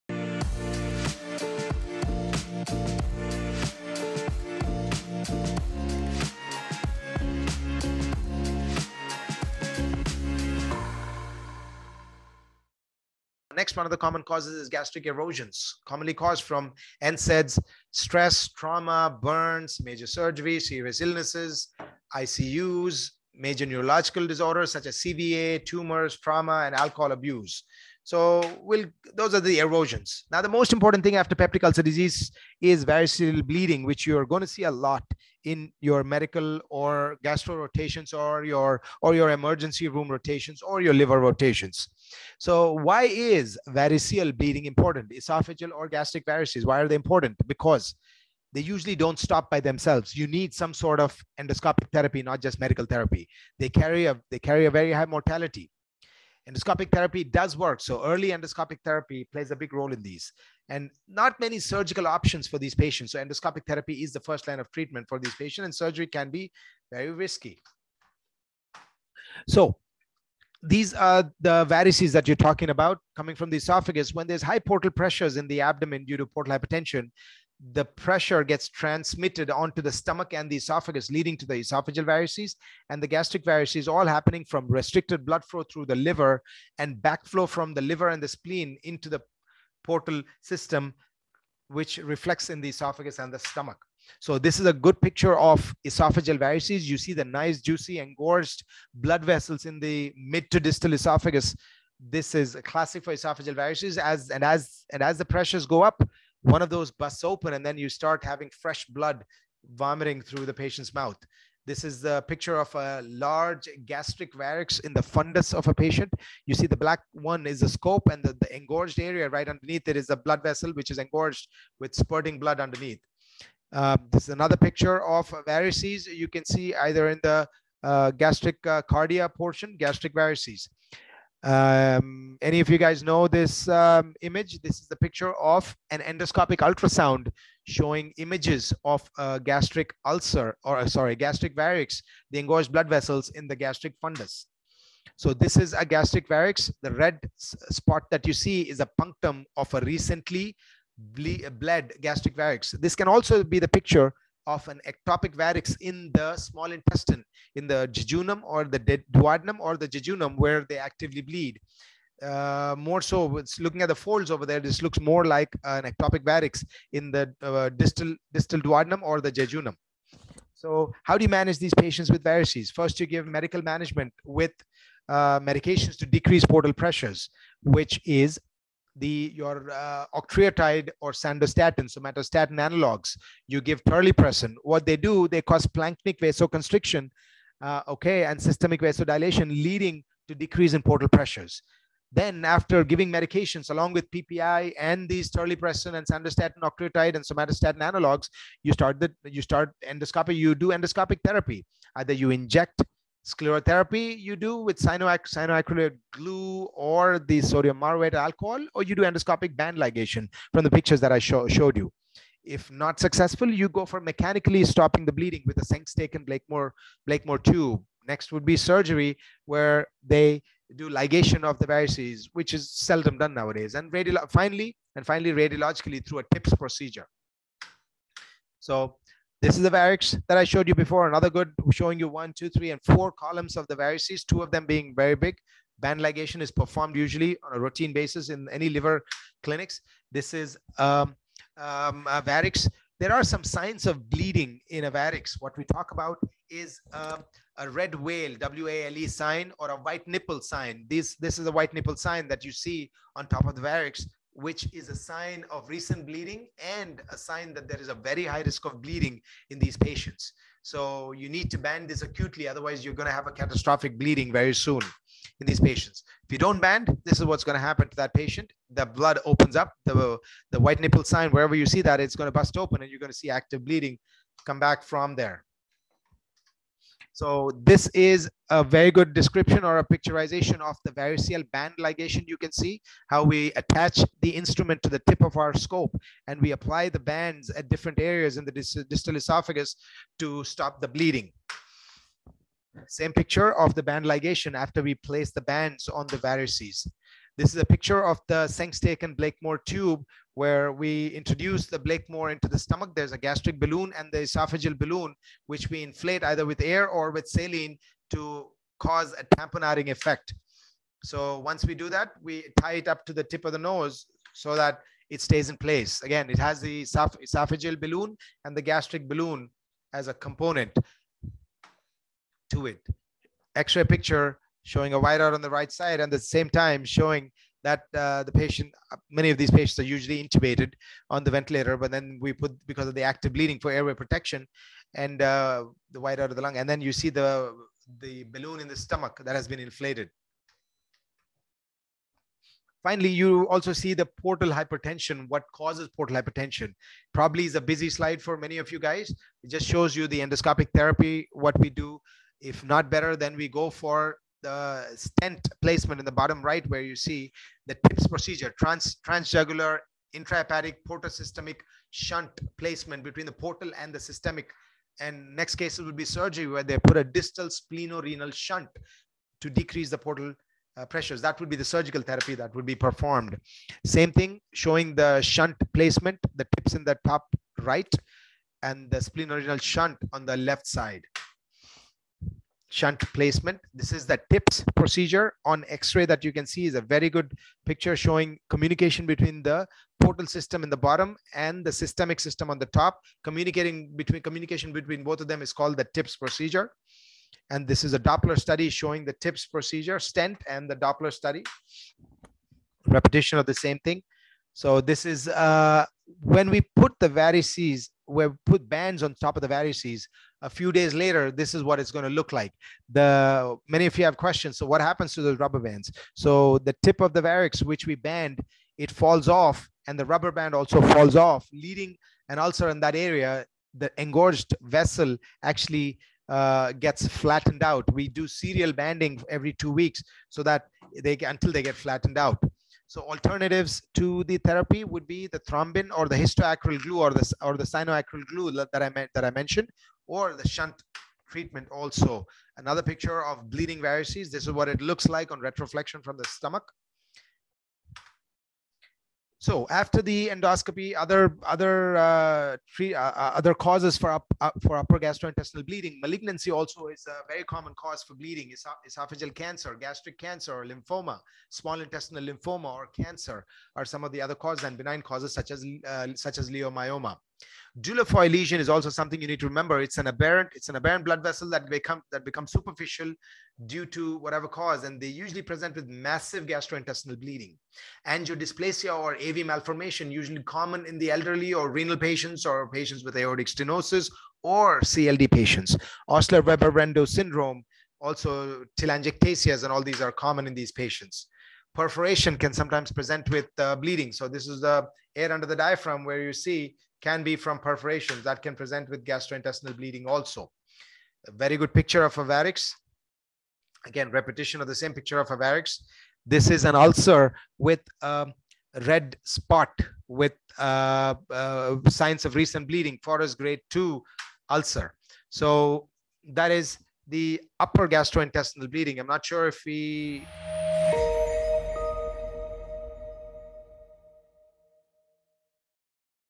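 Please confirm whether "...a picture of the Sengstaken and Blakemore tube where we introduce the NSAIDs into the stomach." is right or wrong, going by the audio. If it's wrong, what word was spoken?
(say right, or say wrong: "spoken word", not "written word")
wrong: "Blakemore", not "NSAIDs".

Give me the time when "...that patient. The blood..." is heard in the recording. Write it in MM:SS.
04:27.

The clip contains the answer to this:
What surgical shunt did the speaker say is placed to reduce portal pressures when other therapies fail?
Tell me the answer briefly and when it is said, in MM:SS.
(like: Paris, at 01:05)
Distal splenorenal shunt, at 06:07.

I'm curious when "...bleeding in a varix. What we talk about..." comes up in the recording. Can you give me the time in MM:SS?
04:04.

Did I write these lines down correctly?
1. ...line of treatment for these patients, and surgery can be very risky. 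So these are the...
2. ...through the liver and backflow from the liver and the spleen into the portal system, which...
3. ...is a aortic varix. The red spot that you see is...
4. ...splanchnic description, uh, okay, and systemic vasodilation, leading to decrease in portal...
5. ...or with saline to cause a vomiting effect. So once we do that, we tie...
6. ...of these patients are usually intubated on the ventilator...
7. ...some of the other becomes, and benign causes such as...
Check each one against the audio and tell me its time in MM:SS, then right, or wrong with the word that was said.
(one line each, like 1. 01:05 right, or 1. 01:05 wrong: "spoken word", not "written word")
1. 01:04 right
2. 01:25 right
3. 02:25 wrong: "gastric", not "aortic"
4. 03:05 wrong: "vasoconstriction", not "description"
5. 05:06 wrong: "tamponading", not "vomiting"
6. 05:29 right
7. 07:43 wrong: "causes", not "becomes".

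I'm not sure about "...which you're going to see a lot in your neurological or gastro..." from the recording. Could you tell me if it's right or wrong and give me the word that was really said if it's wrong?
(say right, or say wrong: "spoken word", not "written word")
wrong: "medical", not "neurological".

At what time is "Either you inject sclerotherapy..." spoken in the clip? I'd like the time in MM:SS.
03:21.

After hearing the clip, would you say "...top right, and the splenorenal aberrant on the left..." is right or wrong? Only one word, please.
wrong.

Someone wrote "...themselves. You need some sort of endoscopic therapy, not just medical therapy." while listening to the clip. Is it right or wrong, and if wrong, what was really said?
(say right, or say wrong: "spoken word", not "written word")
right.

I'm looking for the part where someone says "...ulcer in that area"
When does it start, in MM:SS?
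07:02.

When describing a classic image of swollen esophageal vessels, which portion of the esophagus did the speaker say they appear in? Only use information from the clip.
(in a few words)
Mid to distal esophagus.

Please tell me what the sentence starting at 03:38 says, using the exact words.
Next would be surgery, where they do ligation of the varices, which is seldom done nowadays.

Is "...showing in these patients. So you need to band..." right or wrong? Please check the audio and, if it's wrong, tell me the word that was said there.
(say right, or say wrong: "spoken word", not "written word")
wrong: "bleeding", not "showing".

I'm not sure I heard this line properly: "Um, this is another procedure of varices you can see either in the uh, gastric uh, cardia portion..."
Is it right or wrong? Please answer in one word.
wrong.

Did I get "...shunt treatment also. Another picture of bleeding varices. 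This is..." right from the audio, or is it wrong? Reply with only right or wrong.
right.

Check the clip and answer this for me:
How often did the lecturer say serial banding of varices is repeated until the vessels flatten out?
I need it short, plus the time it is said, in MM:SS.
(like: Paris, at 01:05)
Every 2 weeks, at 07:09.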